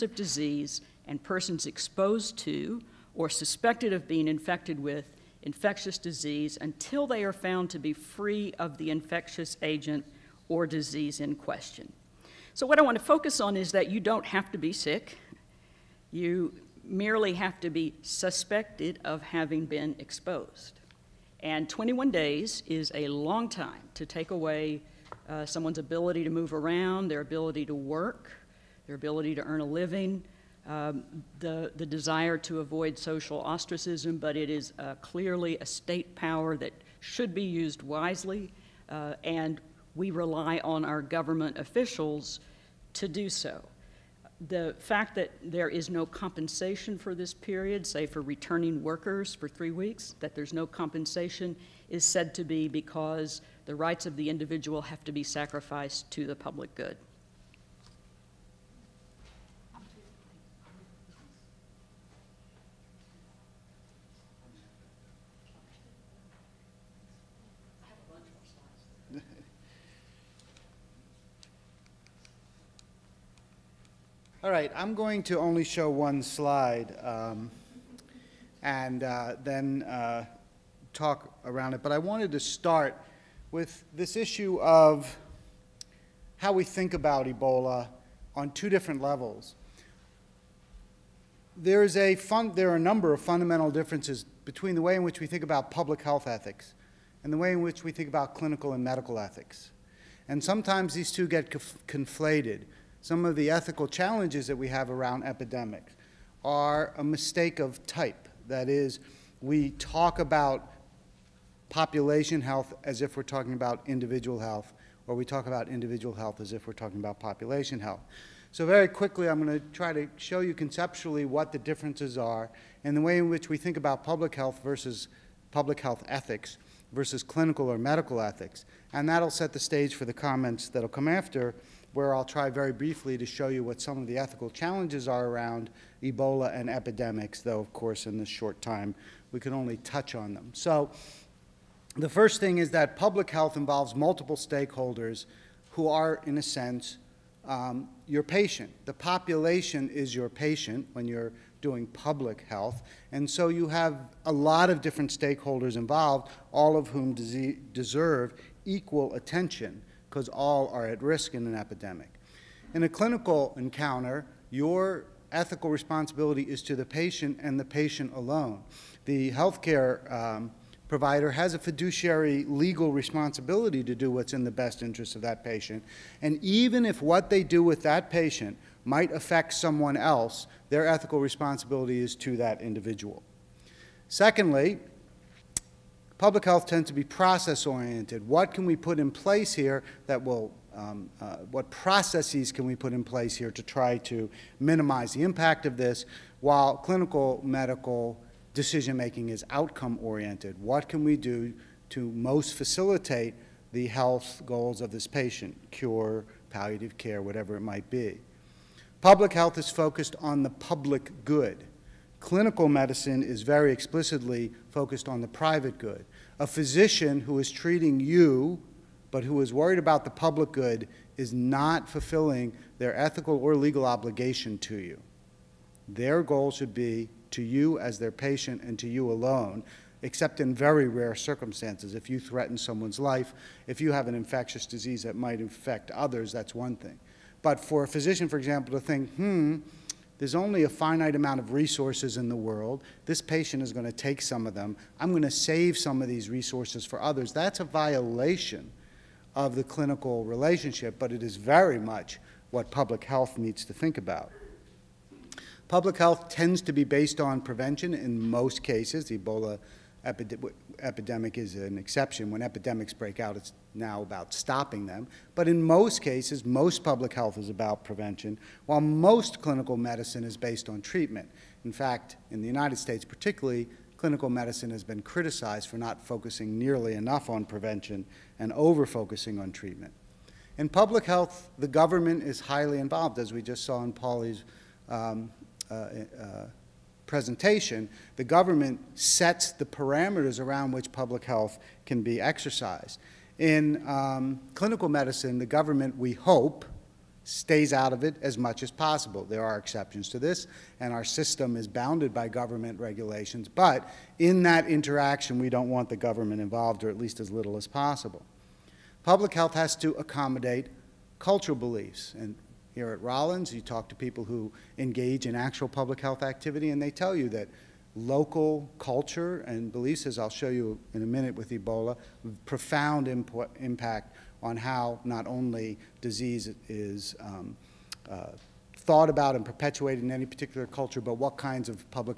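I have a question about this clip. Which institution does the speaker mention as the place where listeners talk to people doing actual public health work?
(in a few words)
Rollins.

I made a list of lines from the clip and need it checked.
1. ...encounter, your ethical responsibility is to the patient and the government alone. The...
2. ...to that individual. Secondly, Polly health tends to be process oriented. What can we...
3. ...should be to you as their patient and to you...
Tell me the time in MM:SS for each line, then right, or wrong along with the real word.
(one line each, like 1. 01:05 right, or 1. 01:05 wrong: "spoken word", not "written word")
1. 02:43 wrong: "patient", not "government"
2. 03:02 wrong: "Public", not "Polly"
3. 03:46 right.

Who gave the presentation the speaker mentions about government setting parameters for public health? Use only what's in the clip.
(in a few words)
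Polly.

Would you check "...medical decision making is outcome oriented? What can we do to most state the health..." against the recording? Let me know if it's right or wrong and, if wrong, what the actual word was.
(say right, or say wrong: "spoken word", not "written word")
wrong: "facilitate", not "state".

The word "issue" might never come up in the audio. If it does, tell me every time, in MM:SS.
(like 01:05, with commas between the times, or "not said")
01:24.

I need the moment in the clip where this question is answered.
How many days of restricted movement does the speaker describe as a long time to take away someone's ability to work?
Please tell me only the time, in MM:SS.
00:21.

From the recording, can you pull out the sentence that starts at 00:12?
So, what I want to focus on is that you don't have to be sick.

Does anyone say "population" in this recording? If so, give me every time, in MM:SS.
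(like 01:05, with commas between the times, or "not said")
01:51, 01:57, 02:28.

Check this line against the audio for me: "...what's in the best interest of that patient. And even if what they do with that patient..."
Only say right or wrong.
right.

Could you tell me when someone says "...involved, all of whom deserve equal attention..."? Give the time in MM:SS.
02:35.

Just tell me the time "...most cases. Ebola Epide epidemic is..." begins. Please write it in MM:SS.
04:18.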